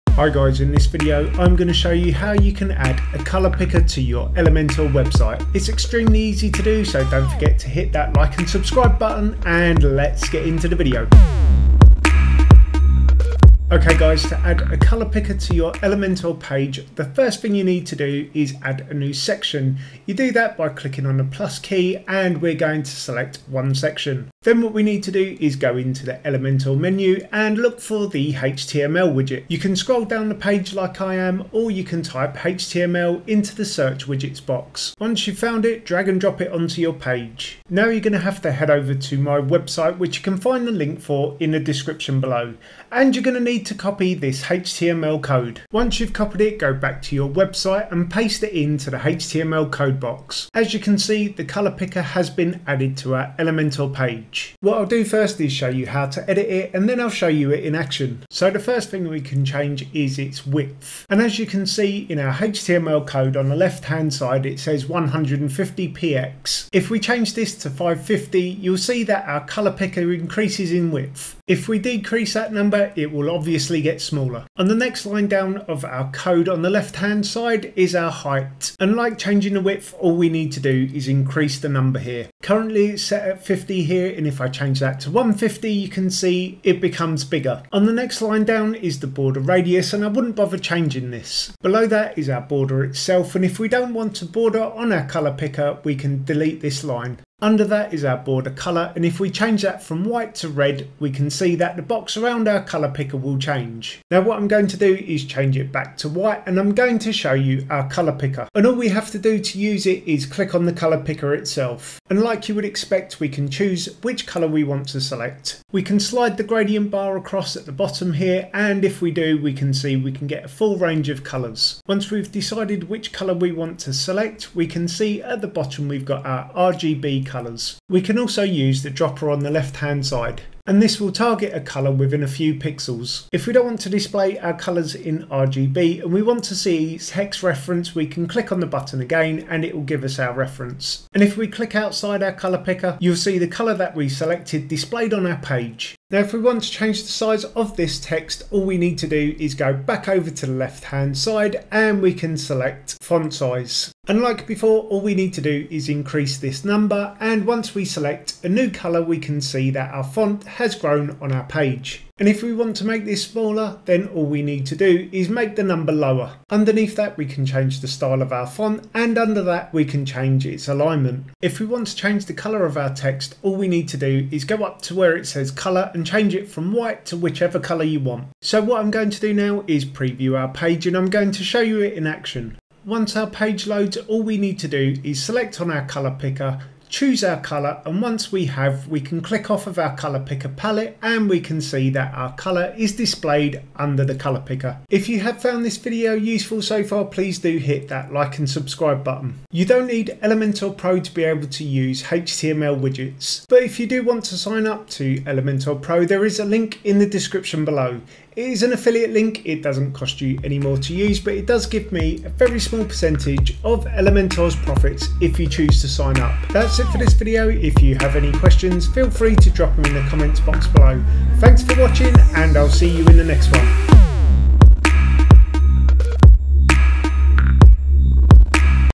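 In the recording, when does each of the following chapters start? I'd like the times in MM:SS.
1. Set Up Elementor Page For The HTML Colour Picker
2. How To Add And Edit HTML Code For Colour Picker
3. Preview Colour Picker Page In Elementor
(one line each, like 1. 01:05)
1. 00:13
2. 00:38
3. 03:00.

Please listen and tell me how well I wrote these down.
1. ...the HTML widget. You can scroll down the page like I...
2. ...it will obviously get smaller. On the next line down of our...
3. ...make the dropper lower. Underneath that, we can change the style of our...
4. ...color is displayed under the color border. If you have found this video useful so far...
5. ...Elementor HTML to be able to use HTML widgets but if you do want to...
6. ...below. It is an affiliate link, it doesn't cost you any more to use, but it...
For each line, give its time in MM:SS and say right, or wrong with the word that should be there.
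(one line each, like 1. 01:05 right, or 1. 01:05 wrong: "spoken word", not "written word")
1. 00:28 right
2. 01:12 right
3. 02:45 wrong: "number", not "dropper"
4. 03:12 wrong: "picker", not "border"
5. 03:20 wrong: "Pro", not "HTML"
6. 03:27 right.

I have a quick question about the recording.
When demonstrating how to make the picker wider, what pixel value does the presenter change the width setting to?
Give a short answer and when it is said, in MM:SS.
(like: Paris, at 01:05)
550, at 01:07.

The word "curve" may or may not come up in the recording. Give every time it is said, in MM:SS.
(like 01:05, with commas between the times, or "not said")
not said.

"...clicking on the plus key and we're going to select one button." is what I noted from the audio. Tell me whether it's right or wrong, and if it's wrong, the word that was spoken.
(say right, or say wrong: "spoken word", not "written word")
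wrong: "section", not "button".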